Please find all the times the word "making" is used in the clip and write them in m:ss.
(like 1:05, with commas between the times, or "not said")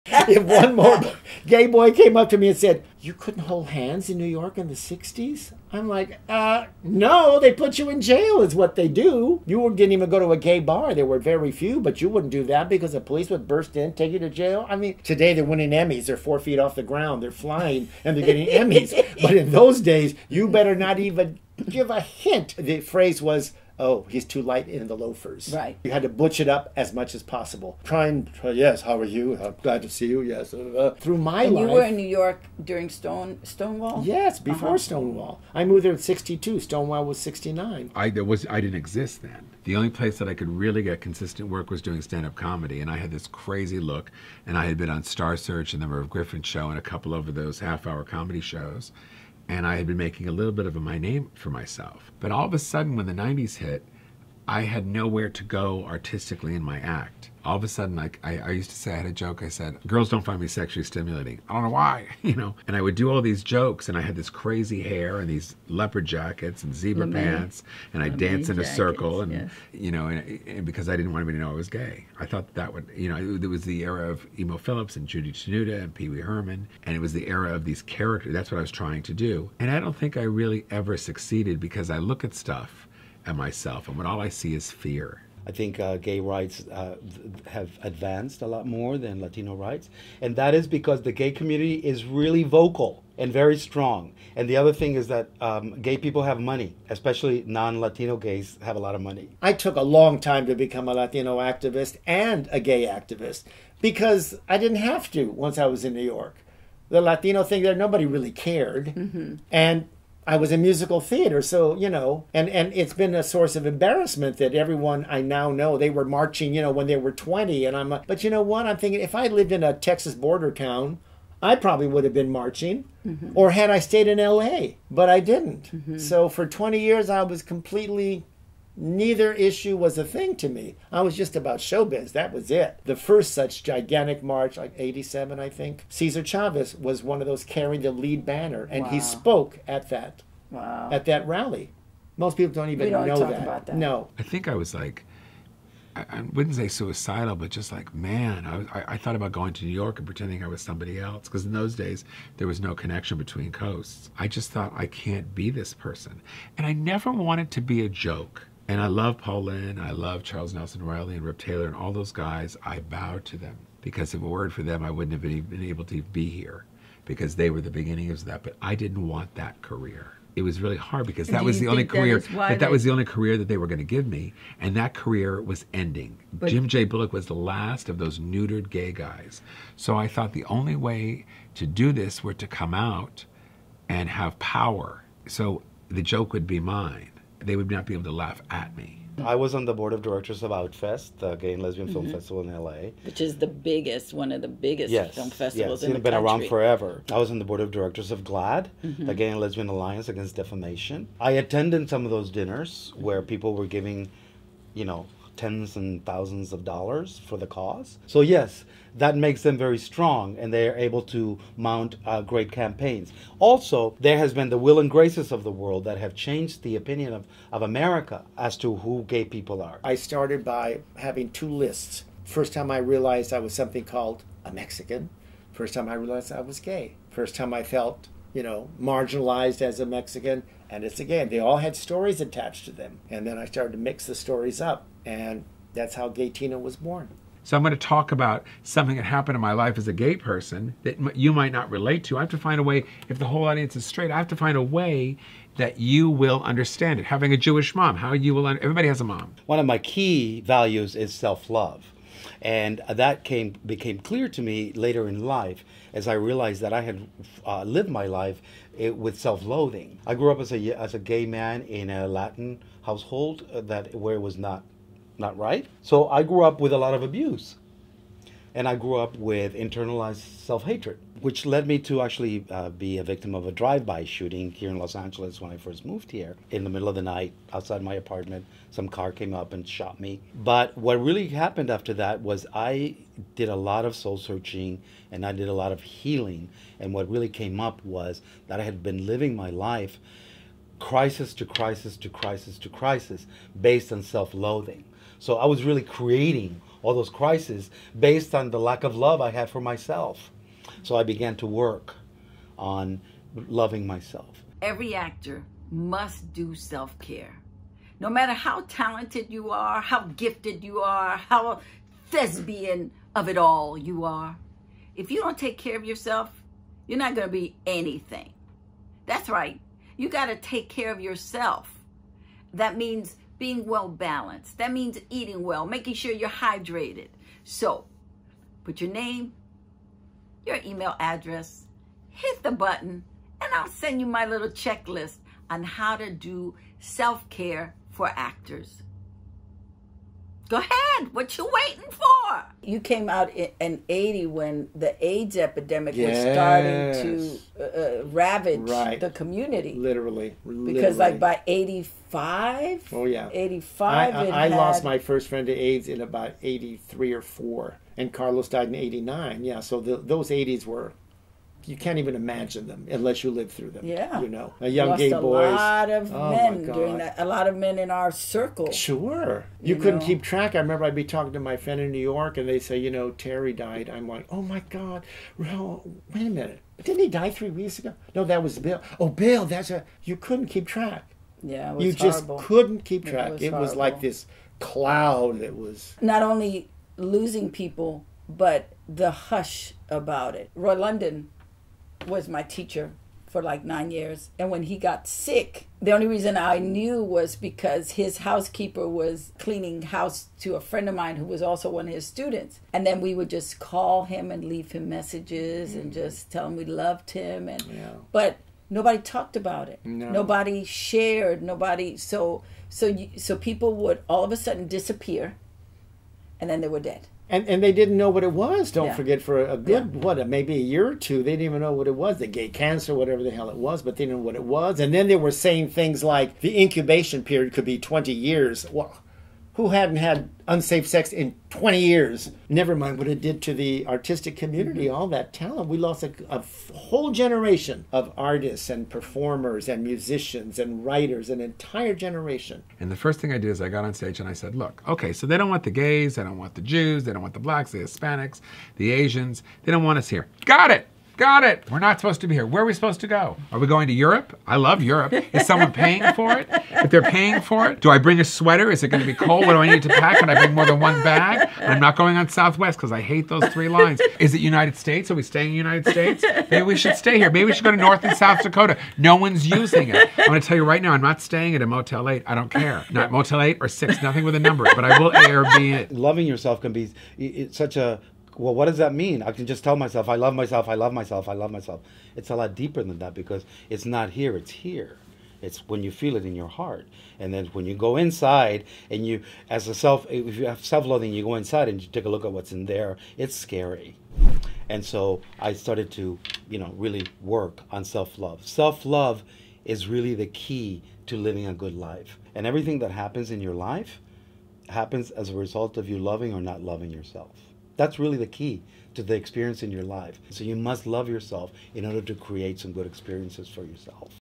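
0:49, 5:25.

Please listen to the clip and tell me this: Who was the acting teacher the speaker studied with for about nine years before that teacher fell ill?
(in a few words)
Roy London.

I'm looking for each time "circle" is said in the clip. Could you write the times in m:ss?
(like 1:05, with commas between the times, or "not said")
1:08, 6:08.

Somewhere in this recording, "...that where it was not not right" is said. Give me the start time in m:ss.
4:23.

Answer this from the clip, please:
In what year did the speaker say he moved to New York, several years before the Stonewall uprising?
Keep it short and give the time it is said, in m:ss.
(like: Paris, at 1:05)
1962, at 0:35.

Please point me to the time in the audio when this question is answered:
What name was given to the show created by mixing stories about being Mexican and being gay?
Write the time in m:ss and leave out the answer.
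3:56.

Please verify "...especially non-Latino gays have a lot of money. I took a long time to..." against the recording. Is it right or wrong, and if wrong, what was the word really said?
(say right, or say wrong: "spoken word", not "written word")
right.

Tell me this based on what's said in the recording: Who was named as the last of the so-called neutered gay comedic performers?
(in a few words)
Jim J. Bullock.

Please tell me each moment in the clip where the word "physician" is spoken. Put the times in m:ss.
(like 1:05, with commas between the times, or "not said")
not said.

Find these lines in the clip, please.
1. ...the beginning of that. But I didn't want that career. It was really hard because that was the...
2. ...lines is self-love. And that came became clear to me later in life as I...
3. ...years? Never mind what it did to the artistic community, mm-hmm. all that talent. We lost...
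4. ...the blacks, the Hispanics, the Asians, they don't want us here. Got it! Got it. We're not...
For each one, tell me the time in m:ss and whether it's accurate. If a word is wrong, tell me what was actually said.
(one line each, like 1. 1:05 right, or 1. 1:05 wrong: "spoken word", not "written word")
1. 2:47 right
2. 4:10 wrong: "values", not "lines"
3. 7:11 right
4. 7:27 right.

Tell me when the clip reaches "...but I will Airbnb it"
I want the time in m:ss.
7:54.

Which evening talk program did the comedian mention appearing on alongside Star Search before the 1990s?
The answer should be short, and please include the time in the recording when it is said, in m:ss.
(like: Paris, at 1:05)
The Merv Griffin Show, at 0:45.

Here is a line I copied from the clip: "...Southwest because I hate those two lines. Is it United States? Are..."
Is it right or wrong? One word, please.
wrong.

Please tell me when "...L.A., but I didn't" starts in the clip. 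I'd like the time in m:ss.
2:04.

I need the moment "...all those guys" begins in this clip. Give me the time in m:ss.
2:41.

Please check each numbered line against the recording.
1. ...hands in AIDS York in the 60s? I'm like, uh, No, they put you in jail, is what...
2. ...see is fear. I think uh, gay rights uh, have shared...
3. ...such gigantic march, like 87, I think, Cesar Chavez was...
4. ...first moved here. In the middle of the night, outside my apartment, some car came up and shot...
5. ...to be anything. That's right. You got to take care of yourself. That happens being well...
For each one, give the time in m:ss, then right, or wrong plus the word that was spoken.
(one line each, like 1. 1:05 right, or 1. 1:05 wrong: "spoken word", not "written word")
1. 0:03 wrong: "New", not "AIDS"
2. 1:24 wrong: "advanced", not "shared"
3. 2:13 right
4. 4:35 right
5. 5:17 wrong: "means", not "happens".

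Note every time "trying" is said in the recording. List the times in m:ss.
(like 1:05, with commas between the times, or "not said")
0:27, 1:18.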